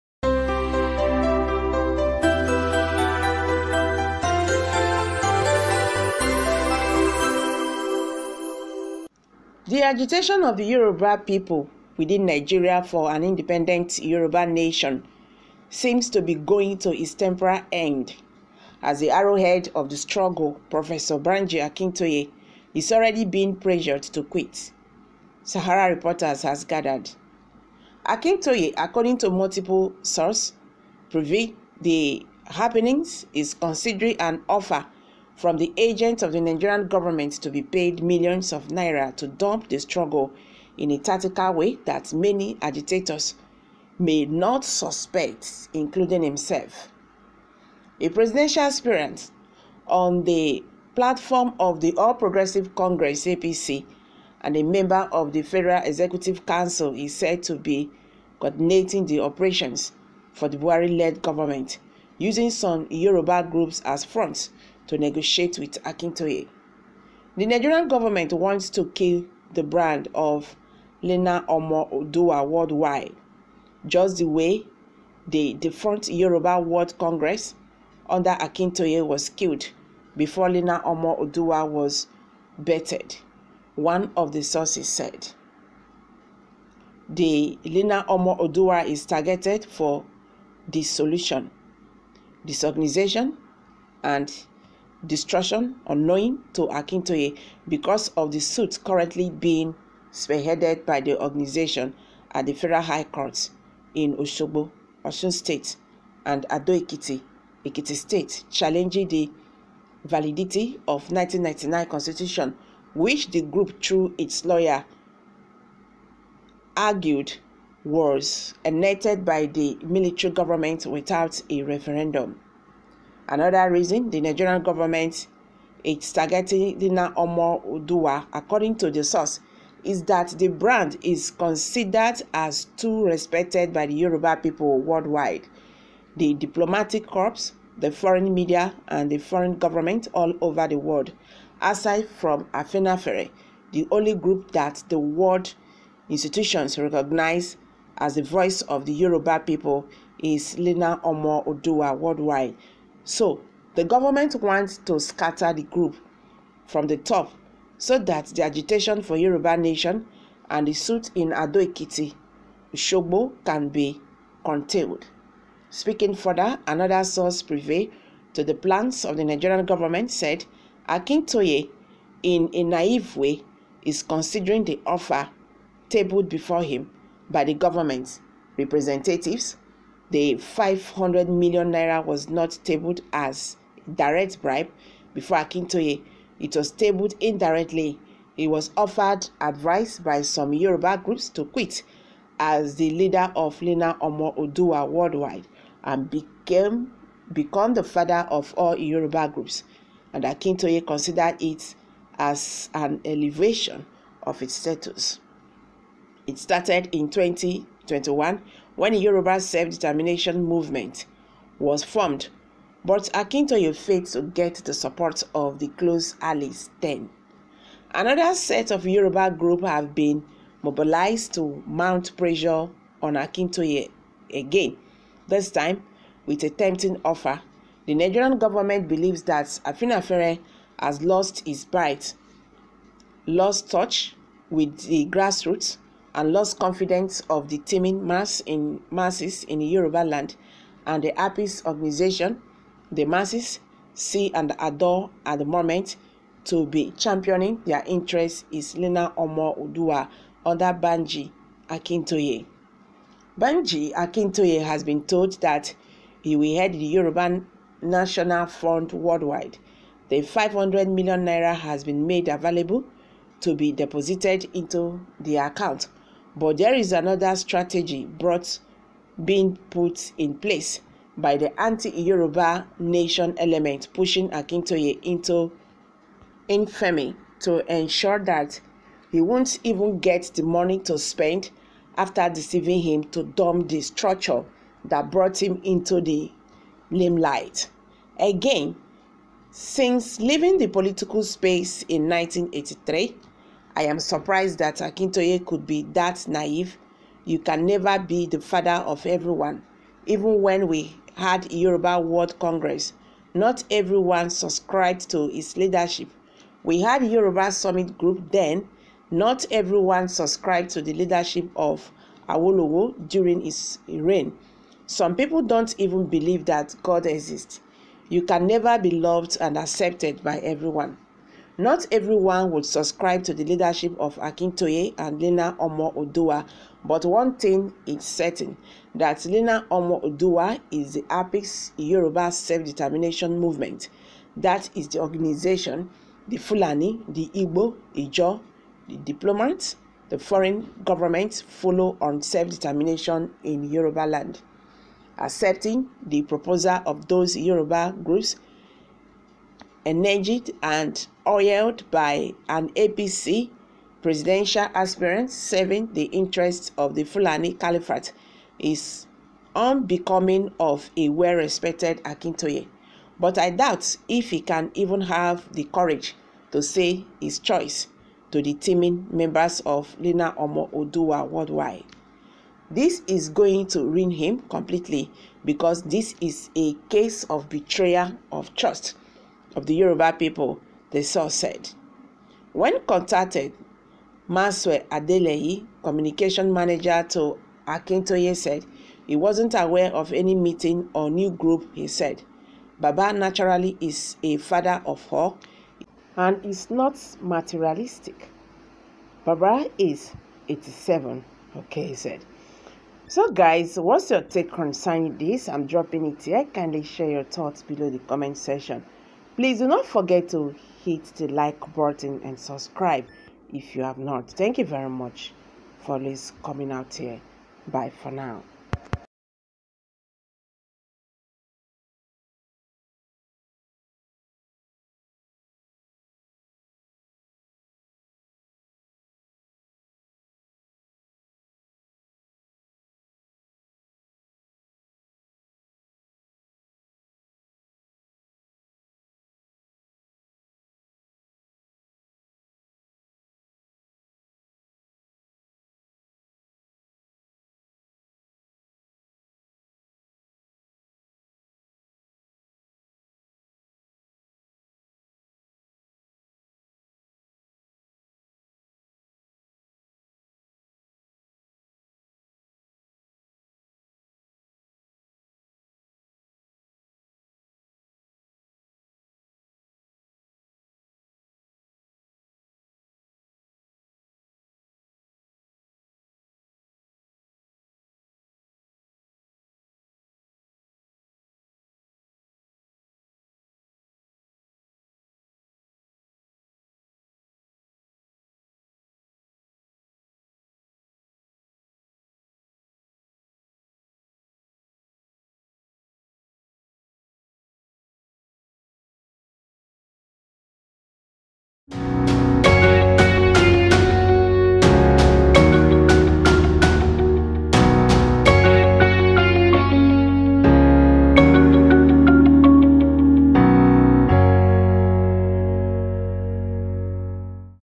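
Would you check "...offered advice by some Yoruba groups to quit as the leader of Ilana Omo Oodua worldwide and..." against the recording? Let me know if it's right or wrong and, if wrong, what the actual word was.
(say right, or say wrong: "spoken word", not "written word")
right.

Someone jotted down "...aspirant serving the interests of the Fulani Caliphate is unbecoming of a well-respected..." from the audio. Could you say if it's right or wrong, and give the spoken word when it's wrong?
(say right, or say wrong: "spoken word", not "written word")
right.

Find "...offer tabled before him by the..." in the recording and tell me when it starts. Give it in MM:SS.
02:54.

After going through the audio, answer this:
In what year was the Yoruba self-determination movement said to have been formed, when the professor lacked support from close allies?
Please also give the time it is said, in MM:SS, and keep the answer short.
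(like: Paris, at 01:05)
2021, at 03:27.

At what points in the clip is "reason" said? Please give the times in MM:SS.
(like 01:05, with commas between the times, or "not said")
02:03.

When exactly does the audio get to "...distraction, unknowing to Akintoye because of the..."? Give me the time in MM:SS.
01:35.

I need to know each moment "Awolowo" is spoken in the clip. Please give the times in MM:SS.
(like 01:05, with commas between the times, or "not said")
05:12.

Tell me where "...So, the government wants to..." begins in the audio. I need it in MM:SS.
02:33.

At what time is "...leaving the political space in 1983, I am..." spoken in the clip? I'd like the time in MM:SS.
04:50.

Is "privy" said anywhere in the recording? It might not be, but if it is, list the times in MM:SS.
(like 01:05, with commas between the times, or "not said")
00:31, 02:47.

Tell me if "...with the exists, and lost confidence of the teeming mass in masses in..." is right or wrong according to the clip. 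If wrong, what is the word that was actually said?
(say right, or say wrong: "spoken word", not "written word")
wrong: "grassroots", not "exists".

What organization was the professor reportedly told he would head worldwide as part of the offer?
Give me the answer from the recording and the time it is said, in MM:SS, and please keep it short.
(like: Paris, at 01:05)
Yoruba National Front, at 04:16.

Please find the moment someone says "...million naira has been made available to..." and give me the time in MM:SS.
04:20.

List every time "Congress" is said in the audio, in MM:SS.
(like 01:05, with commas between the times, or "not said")
00:52, 01:16, 05:02.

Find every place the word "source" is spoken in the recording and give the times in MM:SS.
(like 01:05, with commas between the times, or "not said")
00:30, 01:24, 02:09, 02:47, 06:21.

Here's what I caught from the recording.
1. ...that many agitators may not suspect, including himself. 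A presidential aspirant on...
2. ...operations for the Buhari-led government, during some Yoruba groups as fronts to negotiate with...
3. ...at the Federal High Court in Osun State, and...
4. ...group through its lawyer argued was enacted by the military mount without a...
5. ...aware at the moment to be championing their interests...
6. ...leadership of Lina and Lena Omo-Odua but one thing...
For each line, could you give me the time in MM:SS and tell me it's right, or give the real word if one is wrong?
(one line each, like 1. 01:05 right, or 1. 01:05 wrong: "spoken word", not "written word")
1. 00:41 right
2. 00:59 wrong: "using", not "during"
3. 01:42 right
4. 01:53 wrong: "government", not "mount"
5. 04:04 wrong: "adore", not "aware"
6. 05:23 wrong: "Akintoye", not "Lina".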